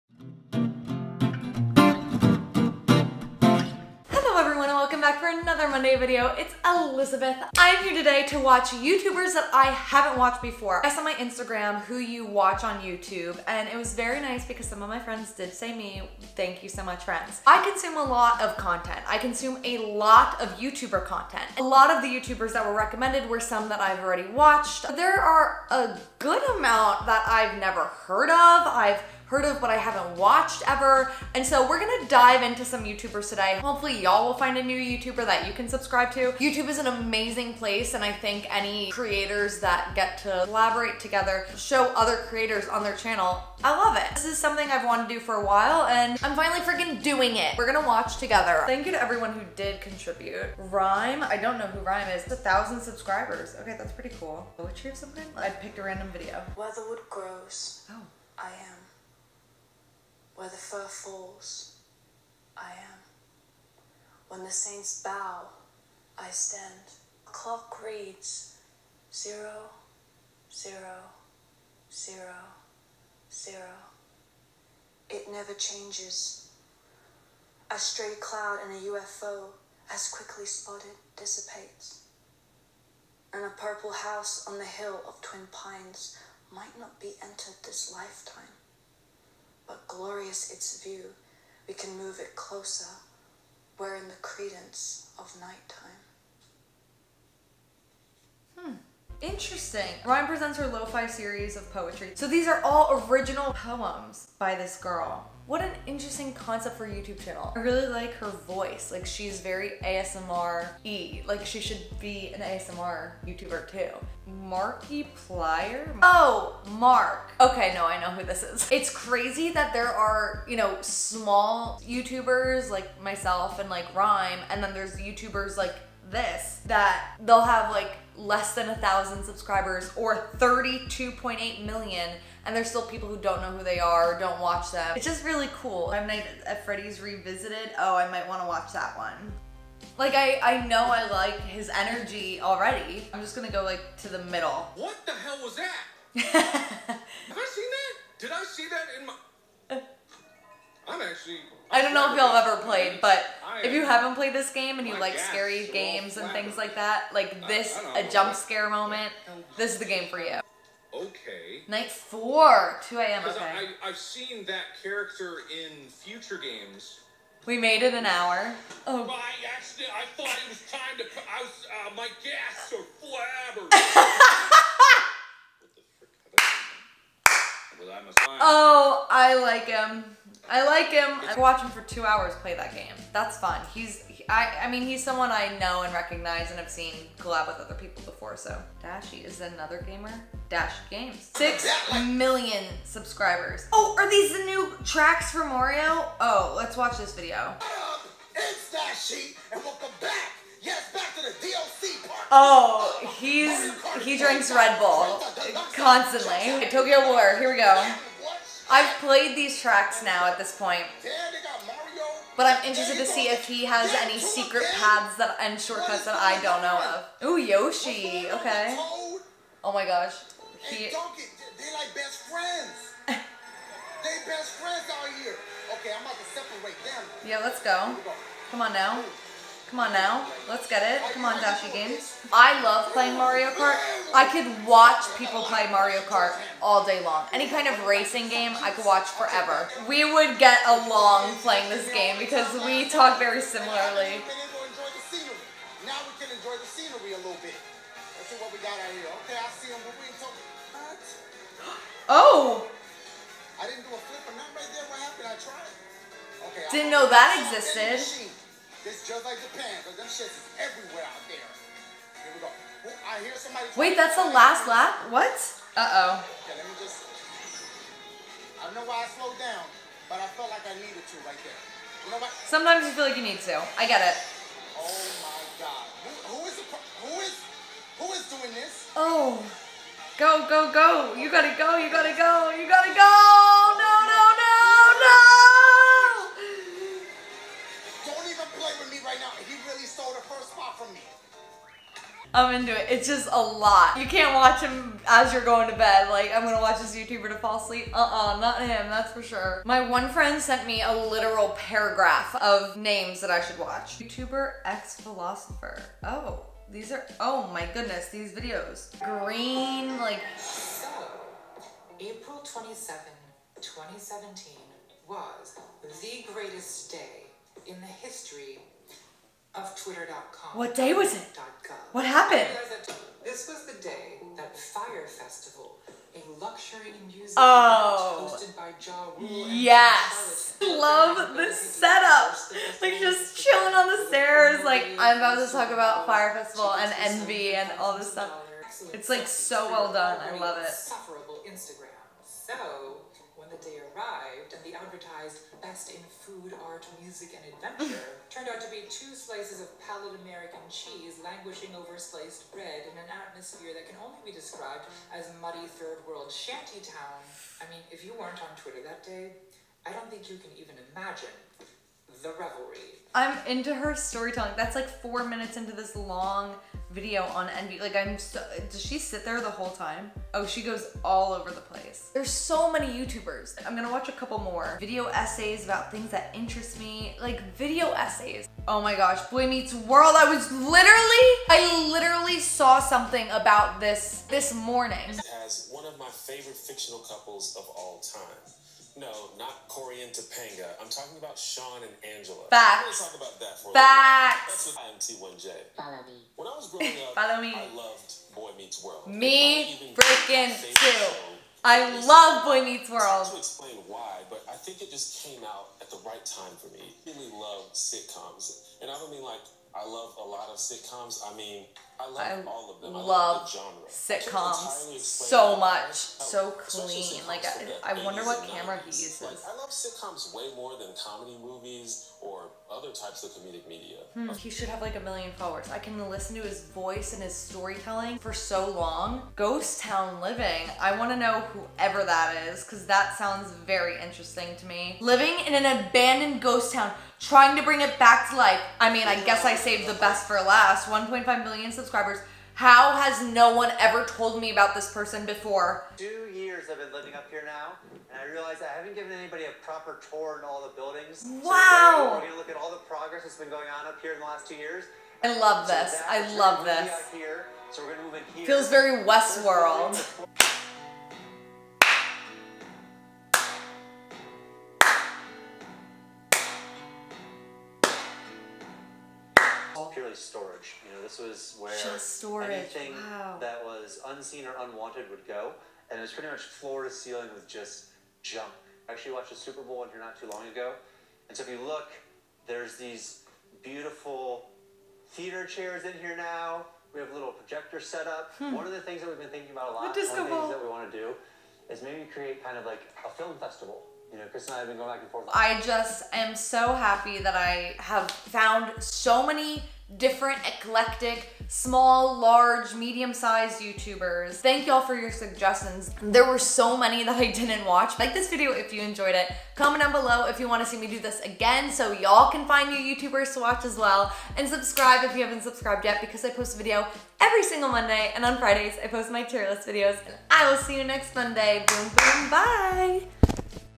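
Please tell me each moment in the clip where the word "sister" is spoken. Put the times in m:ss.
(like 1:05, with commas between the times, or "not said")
not said.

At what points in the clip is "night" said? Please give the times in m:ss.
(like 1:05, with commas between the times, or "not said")
1:35, 2:41.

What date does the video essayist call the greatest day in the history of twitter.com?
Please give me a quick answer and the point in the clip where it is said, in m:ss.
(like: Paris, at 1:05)
April 27, 2017, at 5:11.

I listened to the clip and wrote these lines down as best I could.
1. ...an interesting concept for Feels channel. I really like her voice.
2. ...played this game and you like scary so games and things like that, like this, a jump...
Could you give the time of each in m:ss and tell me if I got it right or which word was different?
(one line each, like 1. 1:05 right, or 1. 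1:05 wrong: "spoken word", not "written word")
1. 1:45 wrong: "YouTube", not "Feels"
2. 2:34 right.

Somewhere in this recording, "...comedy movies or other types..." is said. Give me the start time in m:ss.
7:00.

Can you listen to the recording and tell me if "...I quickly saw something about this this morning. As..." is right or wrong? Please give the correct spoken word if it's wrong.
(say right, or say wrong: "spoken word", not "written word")
wrong: "literally", not "quickly".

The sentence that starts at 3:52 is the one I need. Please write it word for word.
I love playing Mario Kart I could watch people play Mario Kart all day long.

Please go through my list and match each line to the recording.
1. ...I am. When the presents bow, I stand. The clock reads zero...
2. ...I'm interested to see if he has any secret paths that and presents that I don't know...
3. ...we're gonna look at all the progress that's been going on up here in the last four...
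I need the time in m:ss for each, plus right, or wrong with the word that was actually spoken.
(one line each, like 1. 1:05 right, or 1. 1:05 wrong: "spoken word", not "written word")
1. 1:02 wrong: "saints", not "presents"
2. 3:32 wrong: "shortcuts", not "presents"
3. 7:32 wrong: "two", not "four".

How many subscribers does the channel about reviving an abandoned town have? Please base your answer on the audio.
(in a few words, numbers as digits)
1.5 million.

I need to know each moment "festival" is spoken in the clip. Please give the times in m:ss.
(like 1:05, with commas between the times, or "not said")
5:25, 5:36, 8:13.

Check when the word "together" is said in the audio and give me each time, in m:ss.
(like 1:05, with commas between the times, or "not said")
0:40, 0:48.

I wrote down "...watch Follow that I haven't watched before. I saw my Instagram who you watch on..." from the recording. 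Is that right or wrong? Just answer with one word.
wrong.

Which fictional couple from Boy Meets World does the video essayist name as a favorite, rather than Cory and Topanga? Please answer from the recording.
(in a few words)
Shawn and Angela.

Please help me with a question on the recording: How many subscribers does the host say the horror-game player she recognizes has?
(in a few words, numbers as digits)
32.8 million.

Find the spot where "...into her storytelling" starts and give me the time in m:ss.
6:03.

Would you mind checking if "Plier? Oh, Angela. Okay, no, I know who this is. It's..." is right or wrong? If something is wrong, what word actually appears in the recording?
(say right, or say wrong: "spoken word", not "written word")
wrong: "Mark", not "Angela".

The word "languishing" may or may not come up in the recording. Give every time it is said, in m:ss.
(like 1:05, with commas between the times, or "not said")
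5:51.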